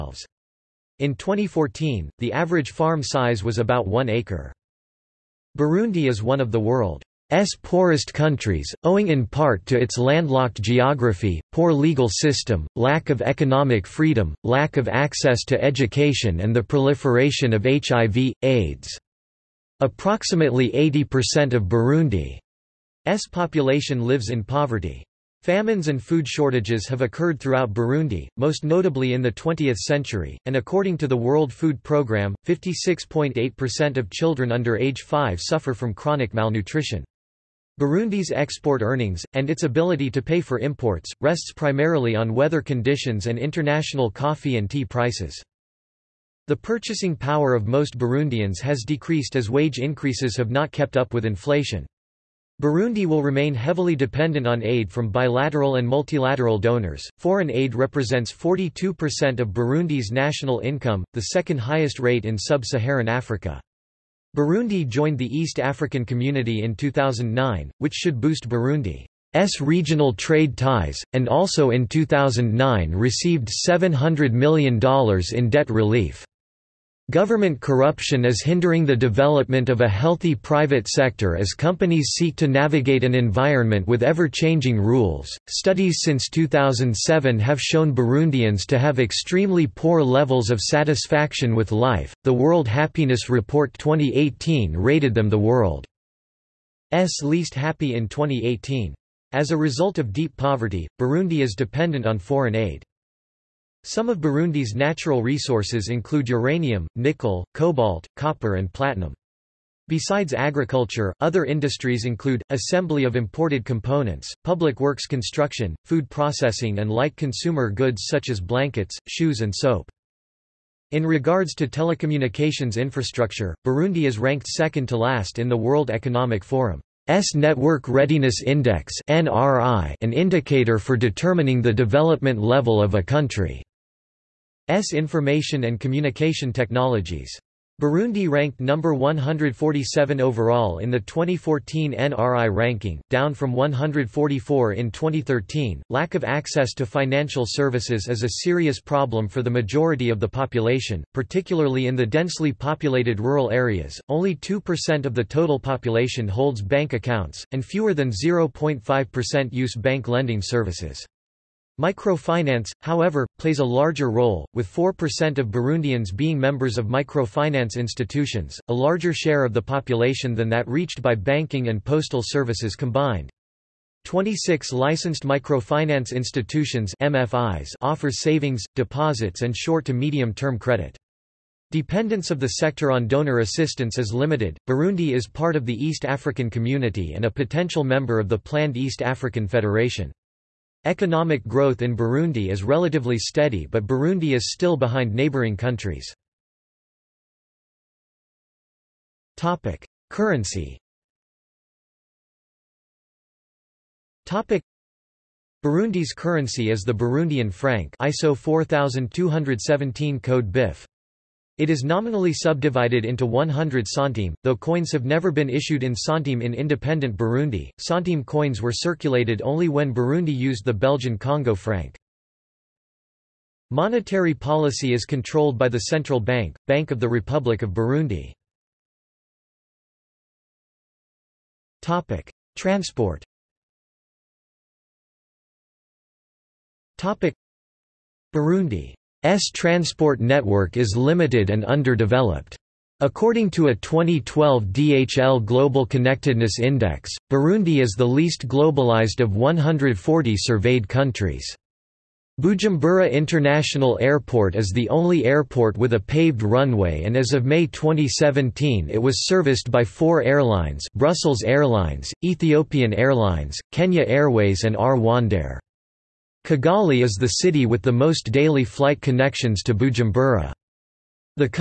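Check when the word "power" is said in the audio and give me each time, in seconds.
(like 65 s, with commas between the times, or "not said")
47 s.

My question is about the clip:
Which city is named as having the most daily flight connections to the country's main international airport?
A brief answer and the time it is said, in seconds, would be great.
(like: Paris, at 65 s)
Kigali, at 266 s.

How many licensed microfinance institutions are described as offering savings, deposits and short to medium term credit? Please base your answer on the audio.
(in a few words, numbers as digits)
26.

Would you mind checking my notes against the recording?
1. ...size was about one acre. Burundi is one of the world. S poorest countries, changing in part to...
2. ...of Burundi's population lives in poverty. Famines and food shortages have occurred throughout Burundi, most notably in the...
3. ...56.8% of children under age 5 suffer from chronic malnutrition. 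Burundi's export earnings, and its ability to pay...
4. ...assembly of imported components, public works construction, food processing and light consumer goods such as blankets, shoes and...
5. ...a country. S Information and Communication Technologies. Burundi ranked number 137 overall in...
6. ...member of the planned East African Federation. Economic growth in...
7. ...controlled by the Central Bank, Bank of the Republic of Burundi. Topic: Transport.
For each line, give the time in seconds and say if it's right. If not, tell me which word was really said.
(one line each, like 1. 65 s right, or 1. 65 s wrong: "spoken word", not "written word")
1. 3 s wrong: "owing", not "changing"
2. 21 s right
3. 32 s right
4. 112 s right
5. 132 s wrong: "147", not "137"
6. 187 s right
7. 225 s right.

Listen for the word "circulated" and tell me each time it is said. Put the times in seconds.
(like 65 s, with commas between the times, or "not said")
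218 s.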